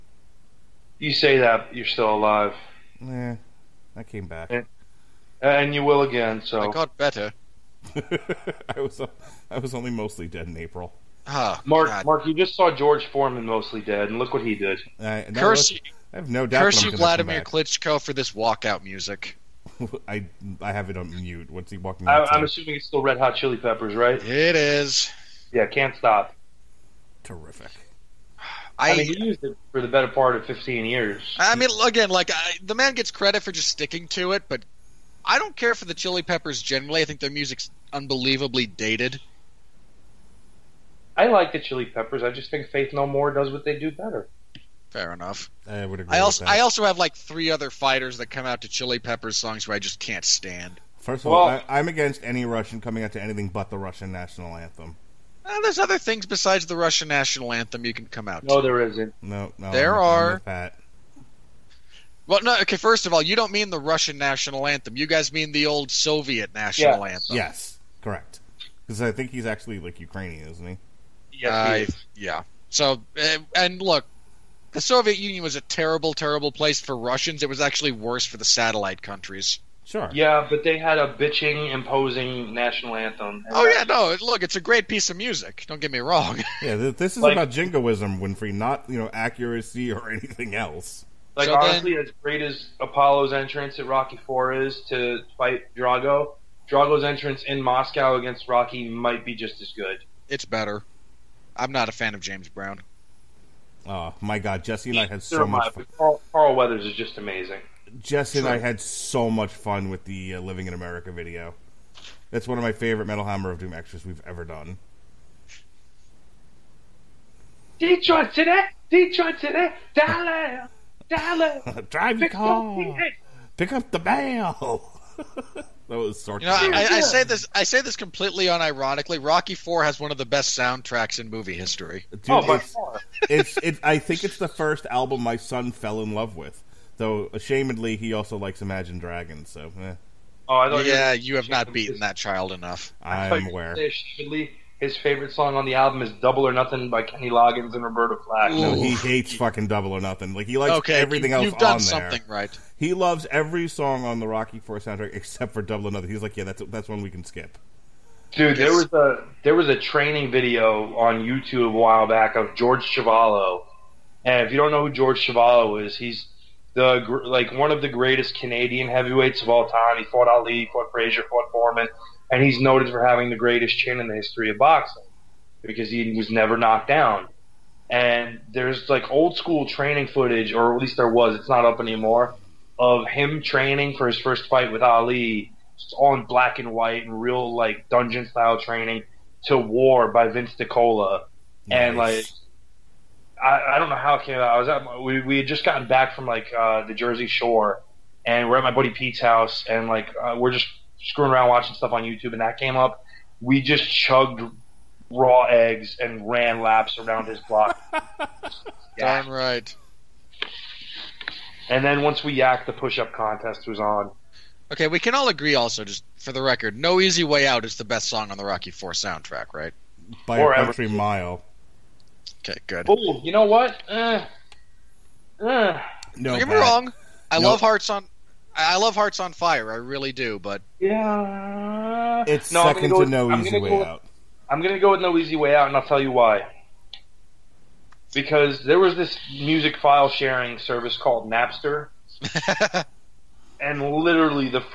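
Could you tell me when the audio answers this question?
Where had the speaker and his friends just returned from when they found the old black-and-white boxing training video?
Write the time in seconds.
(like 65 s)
196 s.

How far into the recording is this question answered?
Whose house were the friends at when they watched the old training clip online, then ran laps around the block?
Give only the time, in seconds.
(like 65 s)
198 s.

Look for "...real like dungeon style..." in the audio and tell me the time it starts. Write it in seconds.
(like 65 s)
187 s.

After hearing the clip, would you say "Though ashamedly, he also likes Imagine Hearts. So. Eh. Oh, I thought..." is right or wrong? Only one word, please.
wrong.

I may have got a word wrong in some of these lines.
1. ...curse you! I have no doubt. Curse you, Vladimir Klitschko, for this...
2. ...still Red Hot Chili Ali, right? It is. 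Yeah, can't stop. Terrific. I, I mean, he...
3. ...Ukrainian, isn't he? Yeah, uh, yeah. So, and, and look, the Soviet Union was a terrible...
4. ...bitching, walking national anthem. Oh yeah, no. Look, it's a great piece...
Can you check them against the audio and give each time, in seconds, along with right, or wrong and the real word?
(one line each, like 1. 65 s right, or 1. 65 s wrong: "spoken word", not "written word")
1. 15 s right
2. 22 s wrong: "Peppers", not "Ali"
3. 69 s right
4. 81 s wrong: "imposing", not "walking".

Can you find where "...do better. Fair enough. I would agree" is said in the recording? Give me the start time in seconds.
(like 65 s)
43 s.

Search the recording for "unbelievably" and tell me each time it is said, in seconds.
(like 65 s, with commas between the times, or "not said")
37 s.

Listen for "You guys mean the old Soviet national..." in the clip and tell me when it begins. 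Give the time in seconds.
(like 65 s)
64 s.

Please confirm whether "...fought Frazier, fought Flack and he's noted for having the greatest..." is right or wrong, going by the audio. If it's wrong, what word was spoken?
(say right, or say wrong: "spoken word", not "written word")
wrong: "Foreman", not "Flack".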